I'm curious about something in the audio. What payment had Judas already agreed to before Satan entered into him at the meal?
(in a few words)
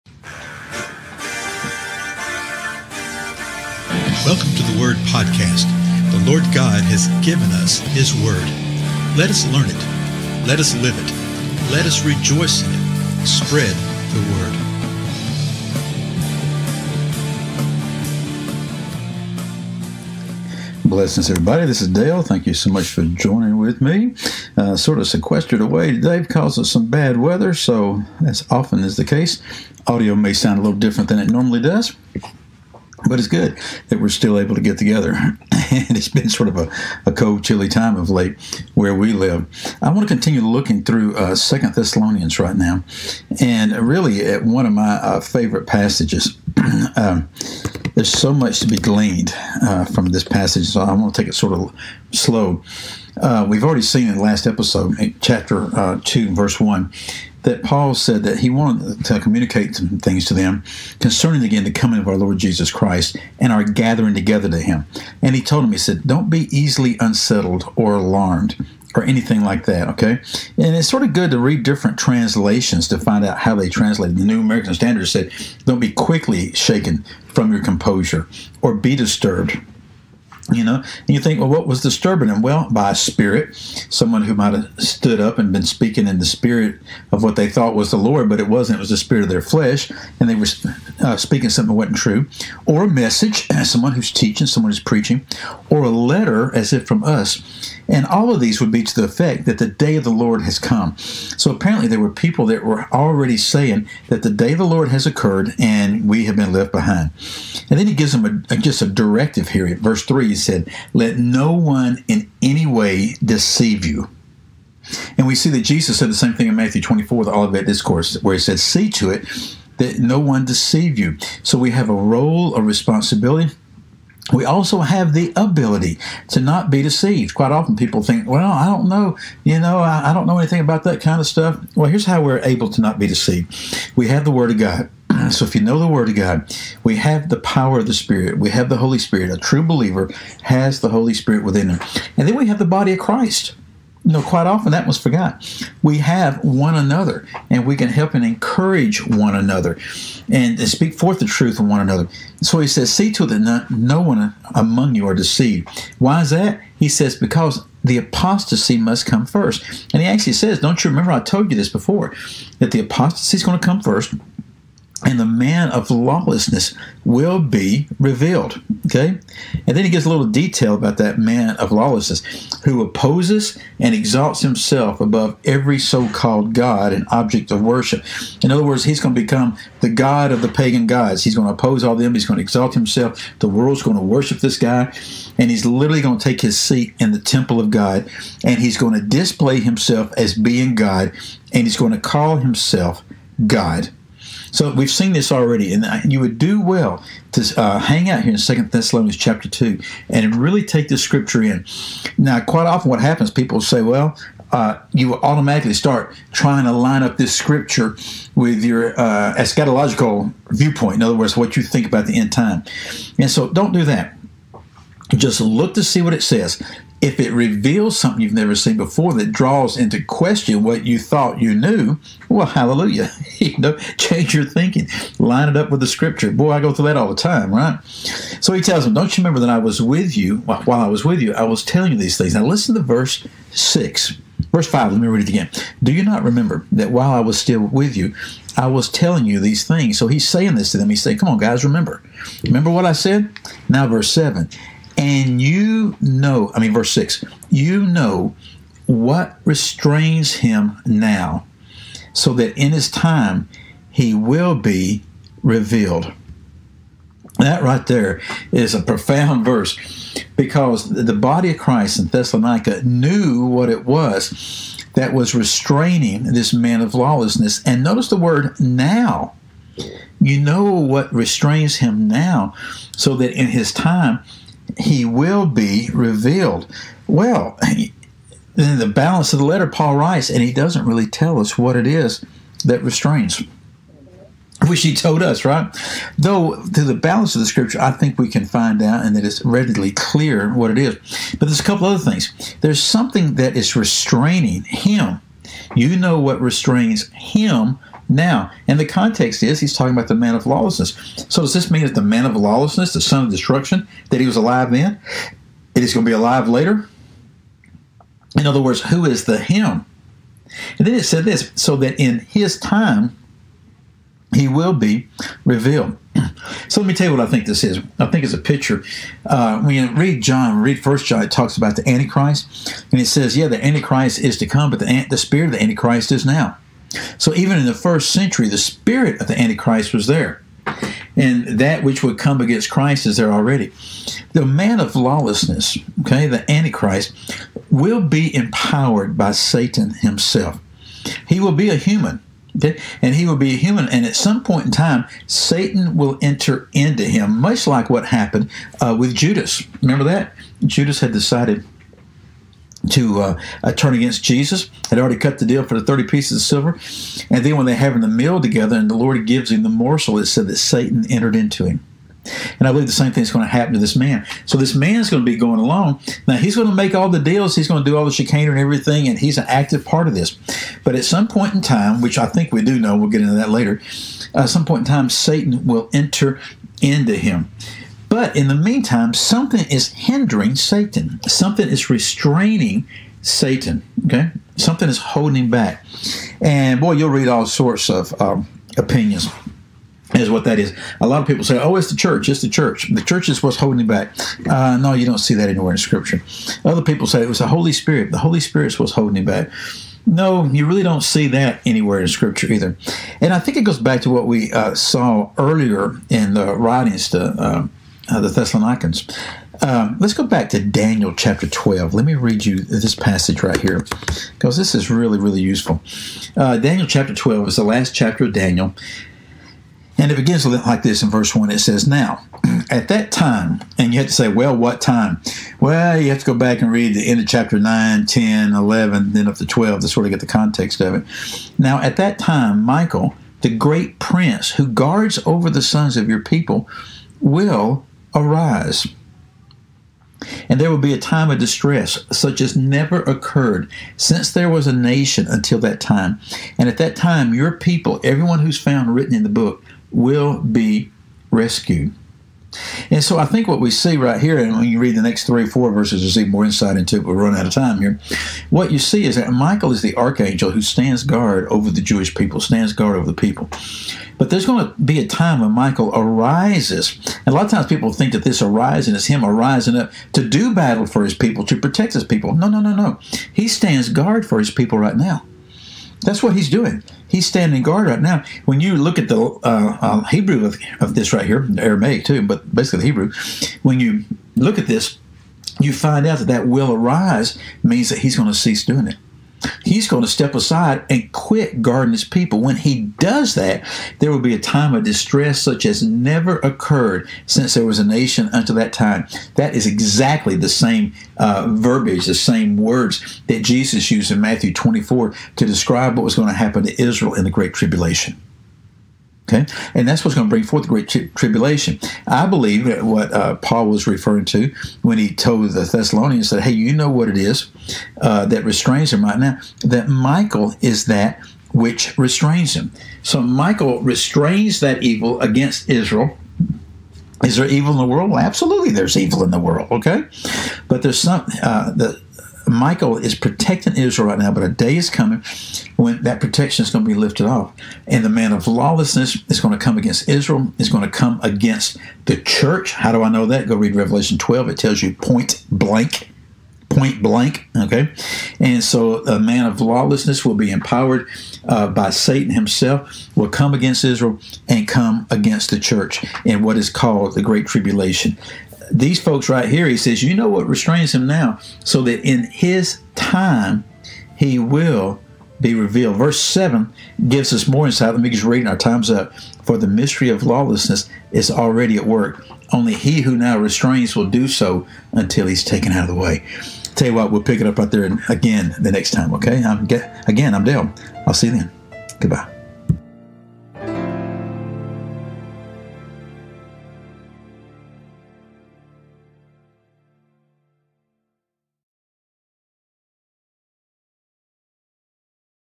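30 pieces of silver.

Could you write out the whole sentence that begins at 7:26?
And at that time, your people, everyone who's found written in the book, will be rescued.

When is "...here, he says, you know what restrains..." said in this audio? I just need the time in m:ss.
9:19.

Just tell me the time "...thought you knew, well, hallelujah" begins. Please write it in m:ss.
3:40.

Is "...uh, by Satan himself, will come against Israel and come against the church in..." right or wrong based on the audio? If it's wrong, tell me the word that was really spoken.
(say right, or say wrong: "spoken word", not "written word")
right.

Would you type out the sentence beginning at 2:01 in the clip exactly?
So we have a role, a responsibility we also have the ability to not be deceived.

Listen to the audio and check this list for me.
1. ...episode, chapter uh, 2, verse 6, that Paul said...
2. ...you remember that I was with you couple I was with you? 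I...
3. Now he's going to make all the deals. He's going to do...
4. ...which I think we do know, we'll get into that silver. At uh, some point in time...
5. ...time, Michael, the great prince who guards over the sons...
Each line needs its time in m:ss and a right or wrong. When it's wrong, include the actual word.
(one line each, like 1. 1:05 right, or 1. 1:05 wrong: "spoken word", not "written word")
1. 0:54 wrong: "1", not "6"
2. 3:49 wrong: "while", not "couple"
3. 6:06 right
4. 6:11 wrong: "later", not "silver"
5. 7:12 right.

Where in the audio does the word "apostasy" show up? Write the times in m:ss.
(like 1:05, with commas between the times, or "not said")
2:37, 2:42.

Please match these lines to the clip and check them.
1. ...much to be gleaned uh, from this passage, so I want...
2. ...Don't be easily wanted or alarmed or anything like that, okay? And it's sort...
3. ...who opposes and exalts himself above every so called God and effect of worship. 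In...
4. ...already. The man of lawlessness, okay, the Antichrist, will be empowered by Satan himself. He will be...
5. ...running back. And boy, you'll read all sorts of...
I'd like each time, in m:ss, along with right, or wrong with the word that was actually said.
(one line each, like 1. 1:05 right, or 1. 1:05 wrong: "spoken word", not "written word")
1. 0:48 right
2. 1:06 wrong: "unsettled", not "wanted"
3. 2:52 wrong: "object", not "effect"
4. 5:33 right
5. 6:24 wrong: "holding", not "running".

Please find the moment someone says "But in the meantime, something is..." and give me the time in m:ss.
6:18.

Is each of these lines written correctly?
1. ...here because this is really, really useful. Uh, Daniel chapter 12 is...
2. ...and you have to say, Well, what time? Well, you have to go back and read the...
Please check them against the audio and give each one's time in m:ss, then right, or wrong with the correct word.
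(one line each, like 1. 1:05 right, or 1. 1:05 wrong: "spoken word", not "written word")
1. 6:53 right
2. 7:03 right.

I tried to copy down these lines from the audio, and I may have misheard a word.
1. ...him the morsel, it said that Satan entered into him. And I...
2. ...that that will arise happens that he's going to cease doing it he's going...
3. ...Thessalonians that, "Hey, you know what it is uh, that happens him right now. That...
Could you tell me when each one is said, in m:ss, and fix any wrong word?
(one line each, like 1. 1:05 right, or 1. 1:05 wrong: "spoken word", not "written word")
1. 5:59 right
2. 8:06 wrong: "means", not "happens"
3. 8:35 wrong: "restrains", not "happens".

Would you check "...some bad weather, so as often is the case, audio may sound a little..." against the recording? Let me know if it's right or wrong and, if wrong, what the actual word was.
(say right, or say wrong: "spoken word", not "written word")
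right.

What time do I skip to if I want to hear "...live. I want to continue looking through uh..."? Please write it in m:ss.
0:39.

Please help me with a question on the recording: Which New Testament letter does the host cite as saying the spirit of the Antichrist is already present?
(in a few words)
First John.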